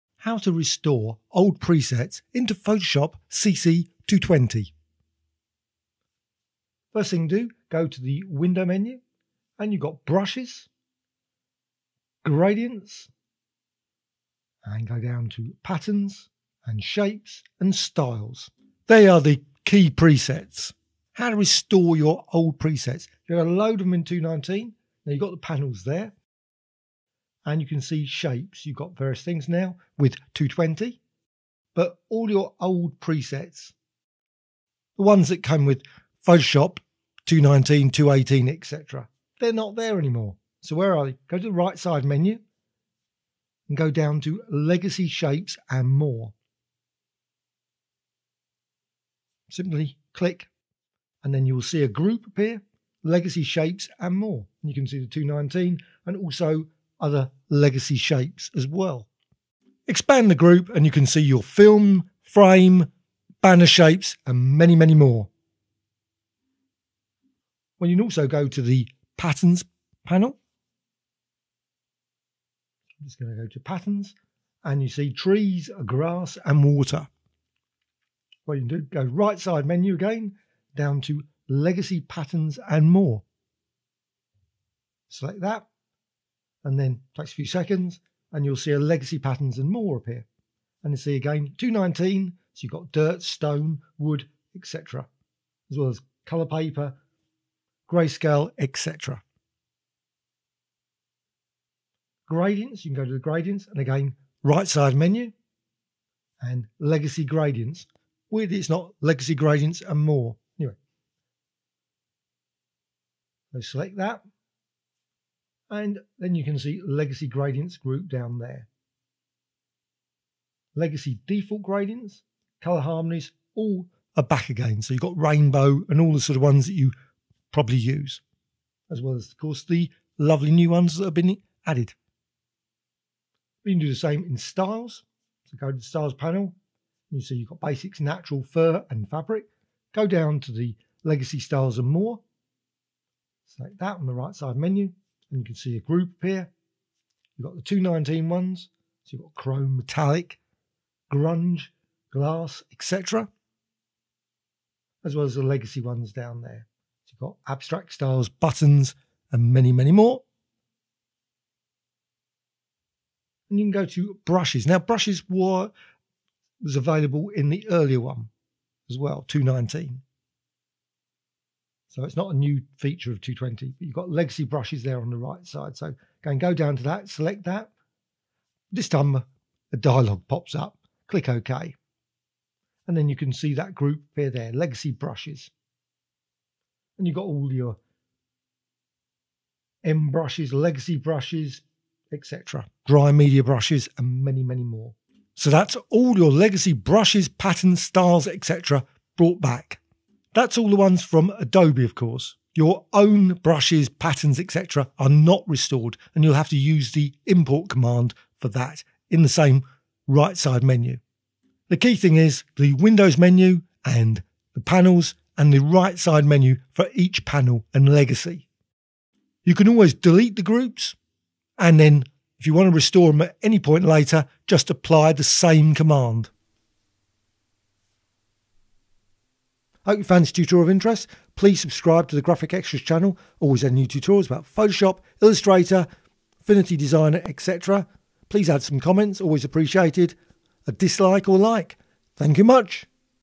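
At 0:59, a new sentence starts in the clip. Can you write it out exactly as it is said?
Expand the group and you can see your film, frame, banner shapes, and many, many more.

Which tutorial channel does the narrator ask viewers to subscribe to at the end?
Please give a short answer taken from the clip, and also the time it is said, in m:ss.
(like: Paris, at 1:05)
Graphicxtras, at 3:52.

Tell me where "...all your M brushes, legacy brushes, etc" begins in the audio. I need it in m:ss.
3:07.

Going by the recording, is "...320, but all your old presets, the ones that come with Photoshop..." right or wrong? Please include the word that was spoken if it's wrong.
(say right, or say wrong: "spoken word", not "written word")
wrong: "220", not "320".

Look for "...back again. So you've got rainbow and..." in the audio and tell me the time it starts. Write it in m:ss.
2:04.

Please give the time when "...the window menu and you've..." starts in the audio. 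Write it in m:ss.
0:08.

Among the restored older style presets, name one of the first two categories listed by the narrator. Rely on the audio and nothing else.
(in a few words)
Chrome.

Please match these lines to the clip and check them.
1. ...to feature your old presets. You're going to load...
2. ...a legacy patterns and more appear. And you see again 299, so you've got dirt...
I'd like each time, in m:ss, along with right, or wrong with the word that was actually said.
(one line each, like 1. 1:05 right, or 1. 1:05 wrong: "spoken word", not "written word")
1. 0:21 wrong: "restore", not "feature"
2. 1:28 wrong: "219", not "299".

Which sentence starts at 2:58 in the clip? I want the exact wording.
This time uh, a dialog pops up, click OK.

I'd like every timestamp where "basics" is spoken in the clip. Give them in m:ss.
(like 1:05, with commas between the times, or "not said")
2:17.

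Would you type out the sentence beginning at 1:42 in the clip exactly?
Gradients, you can go to the gradients, and again, right side menu, and legacy gradients.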